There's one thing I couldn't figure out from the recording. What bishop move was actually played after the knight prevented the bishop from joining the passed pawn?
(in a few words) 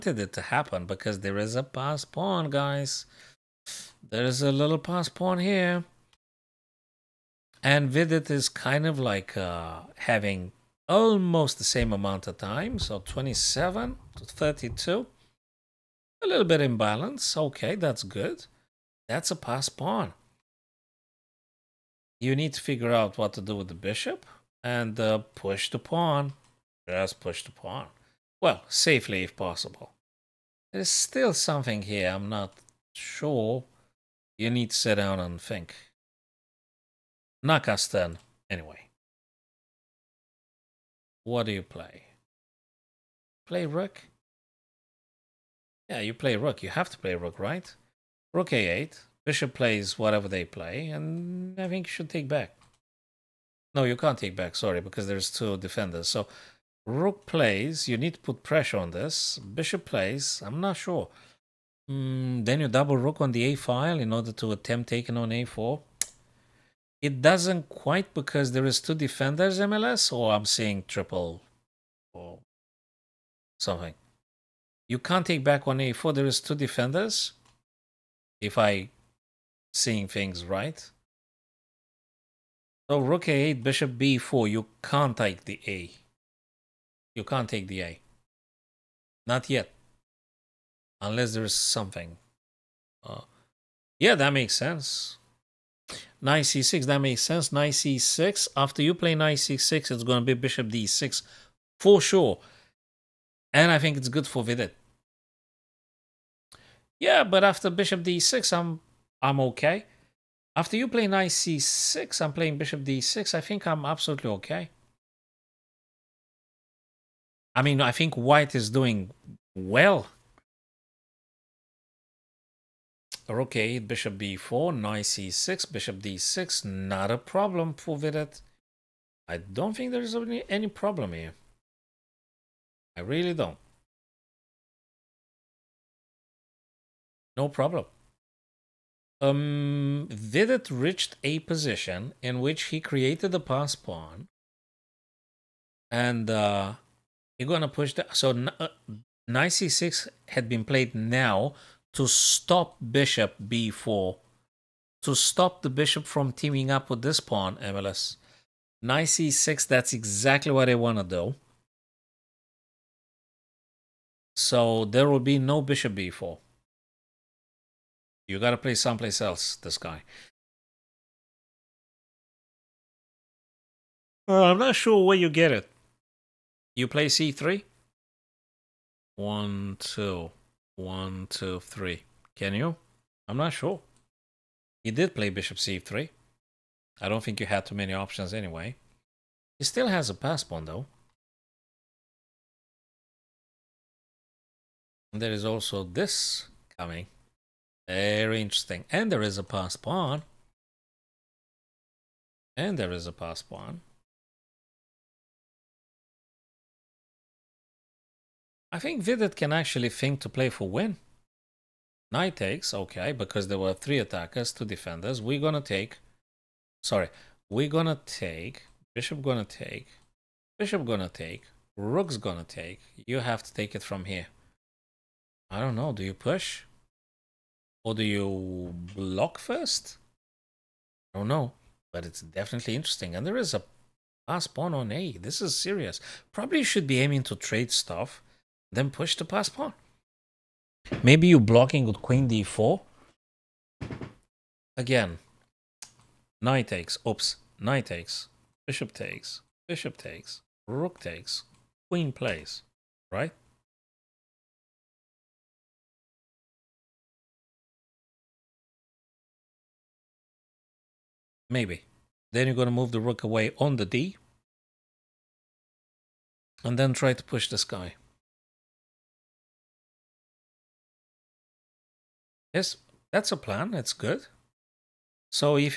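Bishop c3.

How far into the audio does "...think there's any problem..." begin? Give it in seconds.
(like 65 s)
129 s.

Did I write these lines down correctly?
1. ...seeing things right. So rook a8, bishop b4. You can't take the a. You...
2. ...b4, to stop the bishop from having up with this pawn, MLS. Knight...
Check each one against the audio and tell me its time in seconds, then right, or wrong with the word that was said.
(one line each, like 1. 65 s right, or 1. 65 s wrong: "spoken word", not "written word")
1. 79 s right
2. 153 s wrong: "teaming", not "having".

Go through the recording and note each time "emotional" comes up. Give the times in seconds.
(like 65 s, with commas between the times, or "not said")
not said.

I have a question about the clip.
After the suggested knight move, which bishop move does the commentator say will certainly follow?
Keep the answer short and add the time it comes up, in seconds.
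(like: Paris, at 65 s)
Bishop d6, at 100 s.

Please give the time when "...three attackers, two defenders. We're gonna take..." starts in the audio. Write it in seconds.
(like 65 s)
213 s.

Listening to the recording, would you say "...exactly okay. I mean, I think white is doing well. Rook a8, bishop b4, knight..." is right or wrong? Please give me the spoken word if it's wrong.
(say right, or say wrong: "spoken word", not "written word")
wrong: "absolutely", not "exactly".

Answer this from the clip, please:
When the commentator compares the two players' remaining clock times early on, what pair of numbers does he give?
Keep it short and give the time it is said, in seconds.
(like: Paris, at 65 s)
27 to 32, at 12 s.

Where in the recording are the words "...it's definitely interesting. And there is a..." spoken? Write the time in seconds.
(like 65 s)
232 s.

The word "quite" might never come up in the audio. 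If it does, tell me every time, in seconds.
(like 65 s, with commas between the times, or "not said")
67 s.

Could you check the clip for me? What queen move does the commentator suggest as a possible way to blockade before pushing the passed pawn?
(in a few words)
Queen d4.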